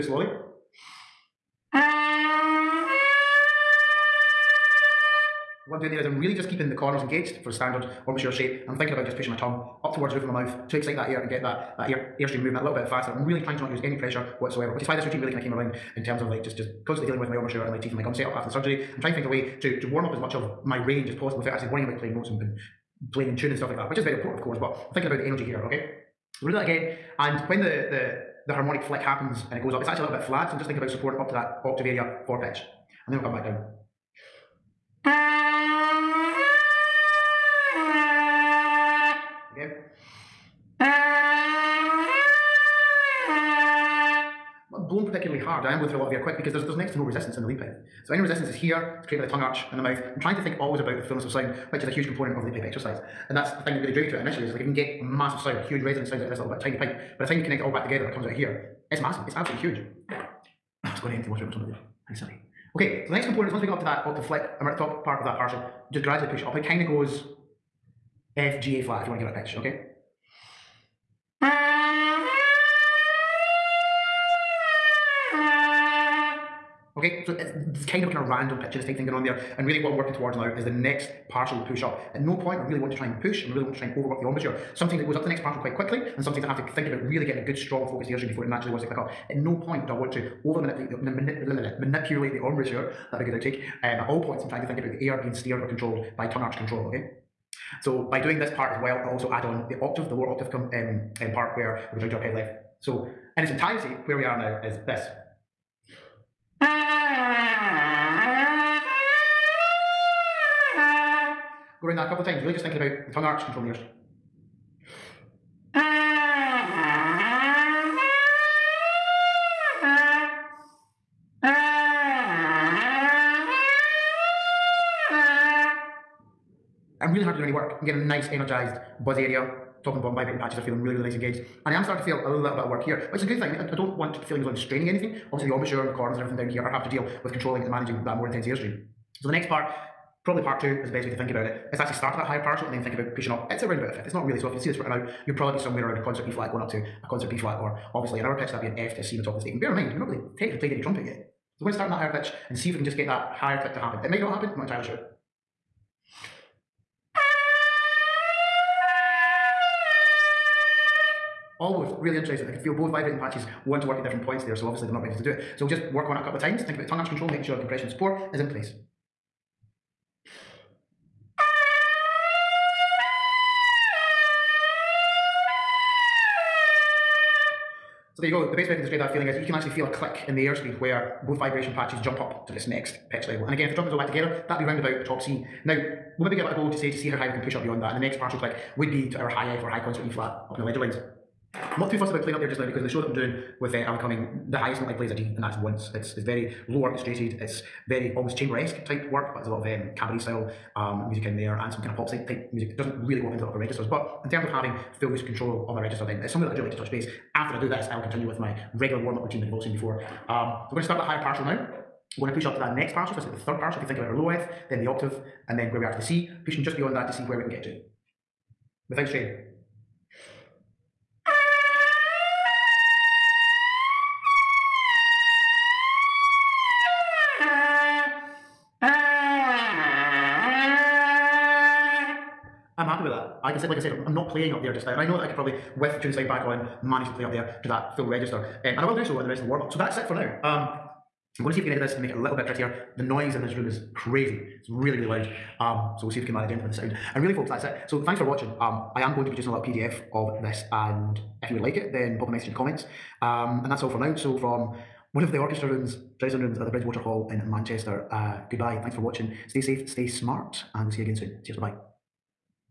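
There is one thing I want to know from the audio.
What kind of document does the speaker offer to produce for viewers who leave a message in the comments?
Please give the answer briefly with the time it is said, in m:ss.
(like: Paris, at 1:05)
PDF, at 4:09.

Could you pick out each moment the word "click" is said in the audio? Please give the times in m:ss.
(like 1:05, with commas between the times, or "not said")
1:28, 2:33, 2:59, 3:08.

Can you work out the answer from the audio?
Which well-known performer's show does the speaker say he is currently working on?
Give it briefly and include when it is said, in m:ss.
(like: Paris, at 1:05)
Alan Cumming, at 3:13.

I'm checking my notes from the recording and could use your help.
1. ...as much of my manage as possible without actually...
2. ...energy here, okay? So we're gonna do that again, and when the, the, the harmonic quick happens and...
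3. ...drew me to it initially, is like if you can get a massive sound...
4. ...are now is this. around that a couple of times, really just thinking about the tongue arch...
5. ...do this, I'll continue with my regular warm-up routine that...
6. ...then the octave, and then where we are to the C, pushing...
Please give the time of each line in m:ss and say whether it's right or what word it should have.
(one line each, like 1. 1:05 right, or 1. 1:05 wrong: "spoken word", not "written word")
1. 0:20 wrong: "range", not "manage"
2. 0:25 wrong: "flick", not "quick"
3. 0:53 right
4. 1:44 right
5. 3:27 right
6. 3:34 right.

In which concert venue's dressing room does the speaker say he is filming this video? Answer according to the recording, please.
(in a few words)
Bridgewater Hall.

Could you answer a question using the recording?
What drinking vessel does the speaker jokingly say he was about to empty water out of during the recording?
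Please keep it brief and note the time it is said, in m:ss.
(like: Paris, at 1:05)
tumbler, at 1:01.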